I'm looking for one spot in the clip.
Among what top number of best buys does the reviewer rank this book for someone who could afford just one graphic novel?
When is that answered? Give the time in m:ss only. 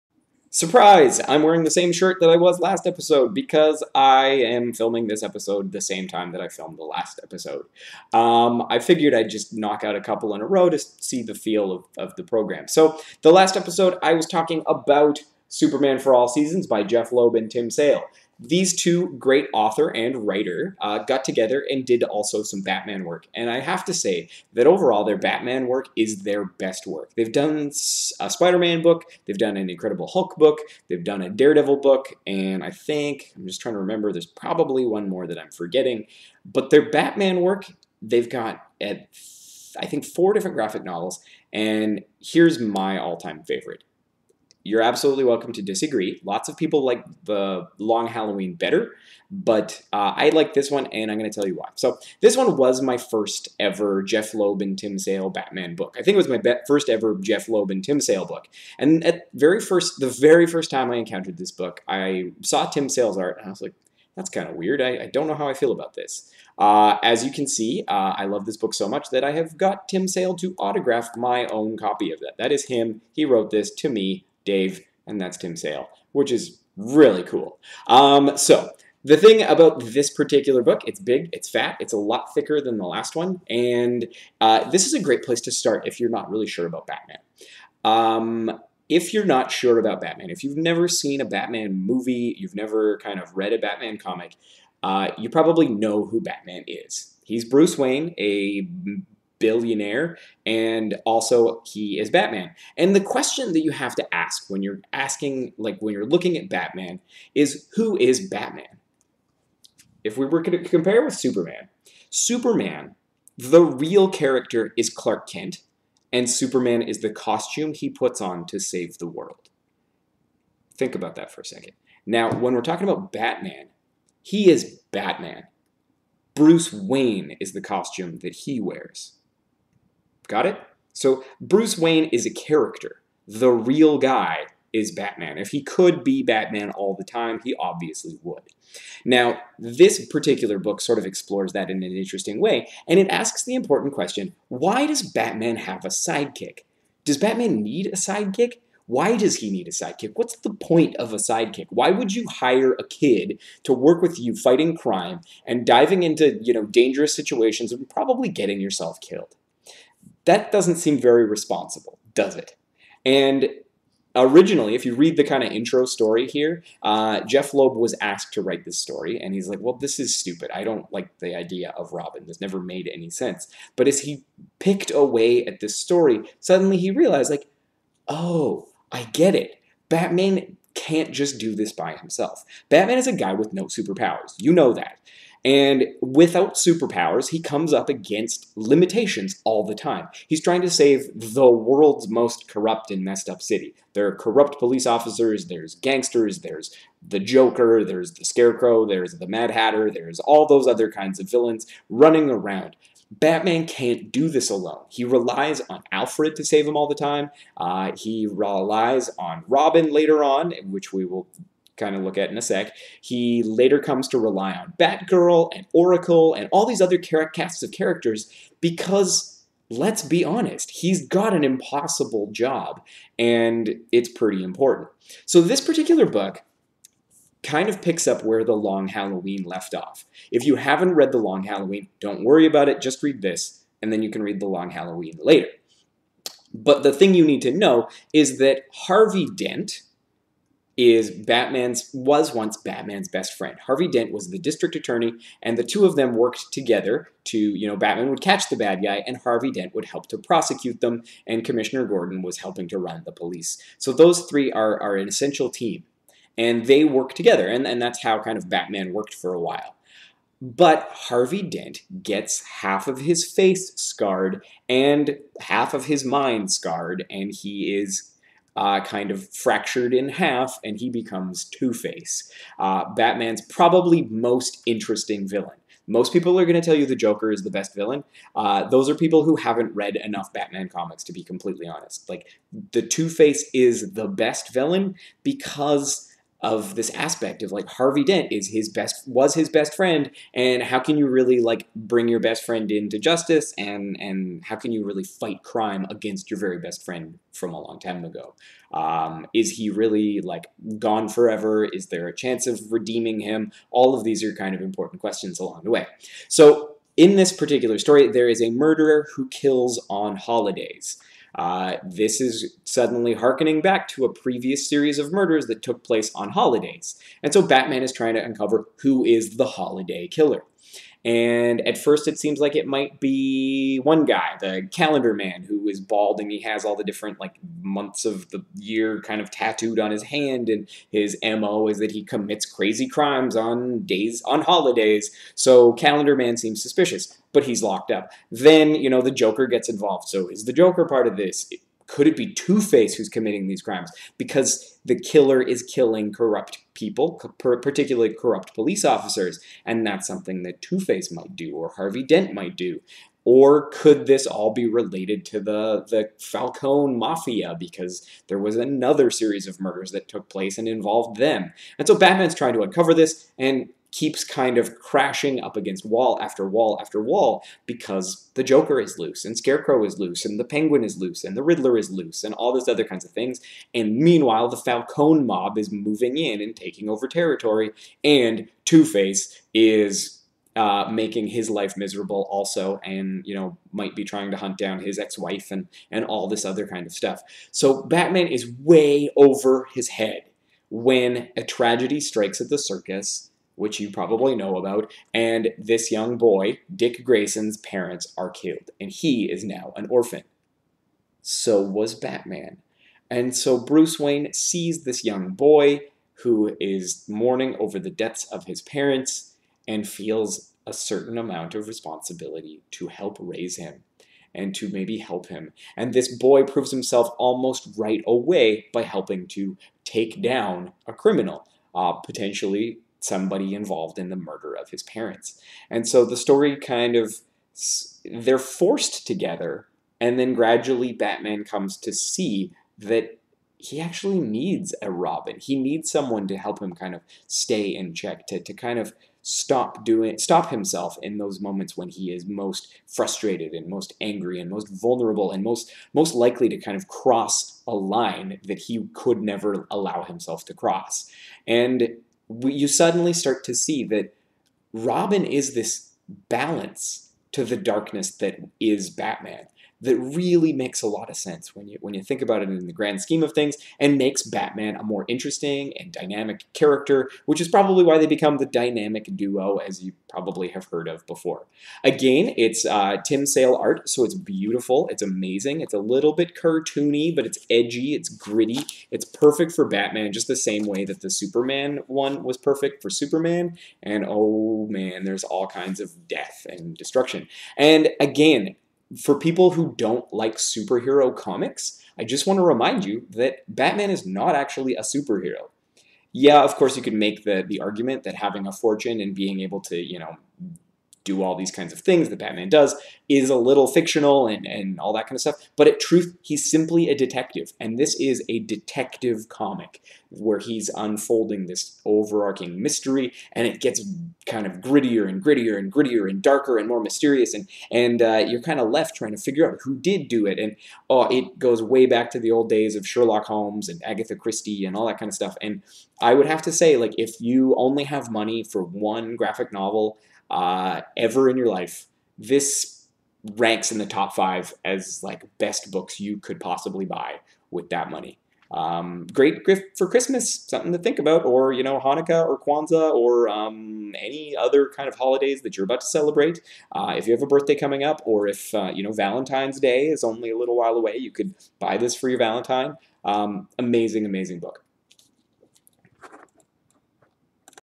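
8:53.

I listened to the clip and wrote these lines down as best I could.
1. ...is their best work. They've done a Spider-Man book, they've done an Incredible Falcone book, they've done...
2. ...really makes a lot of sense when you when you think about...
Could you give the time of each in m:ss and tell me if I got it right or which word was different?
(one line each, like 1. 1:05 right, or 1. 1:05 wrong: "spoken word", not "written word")
1. 0:25 wrong: "Hulk", not "Falcone"
2. 7:39 right.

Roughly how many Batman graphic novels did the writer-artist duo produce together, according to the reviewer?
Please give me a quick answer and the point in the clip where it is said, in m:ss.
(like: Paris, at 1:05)
4, at 0:40.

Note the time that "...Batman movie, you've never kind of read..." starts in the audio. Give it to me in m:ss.
1:31.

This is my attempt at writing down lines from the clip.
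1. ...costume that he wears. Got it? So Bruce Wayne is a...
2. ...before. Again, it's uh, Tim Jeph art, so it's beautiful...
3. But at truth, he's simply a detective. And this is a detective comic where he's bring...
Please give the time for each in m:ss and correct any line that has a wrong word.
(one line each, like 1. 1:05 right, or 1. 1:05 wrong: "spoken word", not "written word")
1. 2:07 right
2. 7:51 wrong: "Sale", not "Jeph"
3. 8:25 wrong: "unfolding", not "bring".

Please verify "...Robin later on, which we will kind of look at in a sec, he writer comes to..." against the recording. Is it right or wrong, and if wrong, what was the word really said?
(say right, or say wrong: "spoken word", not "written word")
wrong: "later", not "writer".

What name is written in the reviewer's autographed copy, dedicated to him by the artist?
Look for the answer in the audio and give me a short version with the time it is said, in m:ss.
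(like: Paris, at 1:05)
Dave, at 1:14.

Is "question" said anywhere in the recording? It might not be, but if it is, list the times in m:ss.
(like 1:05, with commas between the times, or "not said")
1:43, 2:23, 5:04.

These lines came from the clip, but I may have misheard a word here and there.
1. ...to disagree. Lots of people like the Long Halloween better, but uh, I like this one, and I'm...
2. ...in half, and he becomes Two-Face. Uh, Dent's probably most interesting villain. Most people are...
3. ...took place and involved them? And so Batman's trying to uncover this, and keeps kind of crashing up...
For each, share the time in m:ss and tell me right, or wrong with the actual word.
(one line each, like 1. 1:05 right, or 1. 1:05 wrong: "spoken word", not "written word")
1. 0:45 right
2. 4:29 wrong: "Batman", not "Dent"
3. 6:00 right.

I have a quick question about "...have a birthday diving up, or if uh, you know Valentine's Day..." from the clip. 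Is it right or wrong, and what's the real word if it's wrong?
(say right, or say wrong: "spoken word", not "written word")
wrong: "coming", not "diving".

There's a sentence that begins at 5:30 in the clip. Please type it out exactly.
And his MO is that he commits crazy crimes on days, on holidays.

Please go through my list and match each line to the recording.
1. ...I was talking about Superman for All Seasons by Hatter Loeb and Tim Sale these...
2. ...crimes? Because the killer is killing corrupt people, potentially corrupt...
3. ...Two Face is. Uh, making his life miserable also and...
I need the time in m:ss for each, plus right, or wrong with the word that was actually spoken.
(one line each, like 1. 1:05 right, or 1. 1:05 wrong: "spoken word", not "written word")
1. 0:14 wrong: "Jeph", not "Hatter"
2. 5:43 wrong: "particularly", not "potentially"
3. 6:18 right.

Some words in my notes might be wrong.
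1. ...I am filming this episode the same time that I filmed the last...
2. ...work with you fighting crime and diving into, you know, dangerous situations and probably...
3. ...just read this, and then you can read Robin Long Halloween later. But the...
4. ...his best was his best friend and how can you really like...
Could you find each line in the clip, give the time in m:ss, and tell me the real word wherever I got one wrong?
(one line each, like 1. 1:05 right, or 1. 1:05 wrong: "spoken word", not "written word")
1. 0:03 right
2. 2:33 right
3. 3:52 wrong: "The", not "Robin"
4. 4:48 right.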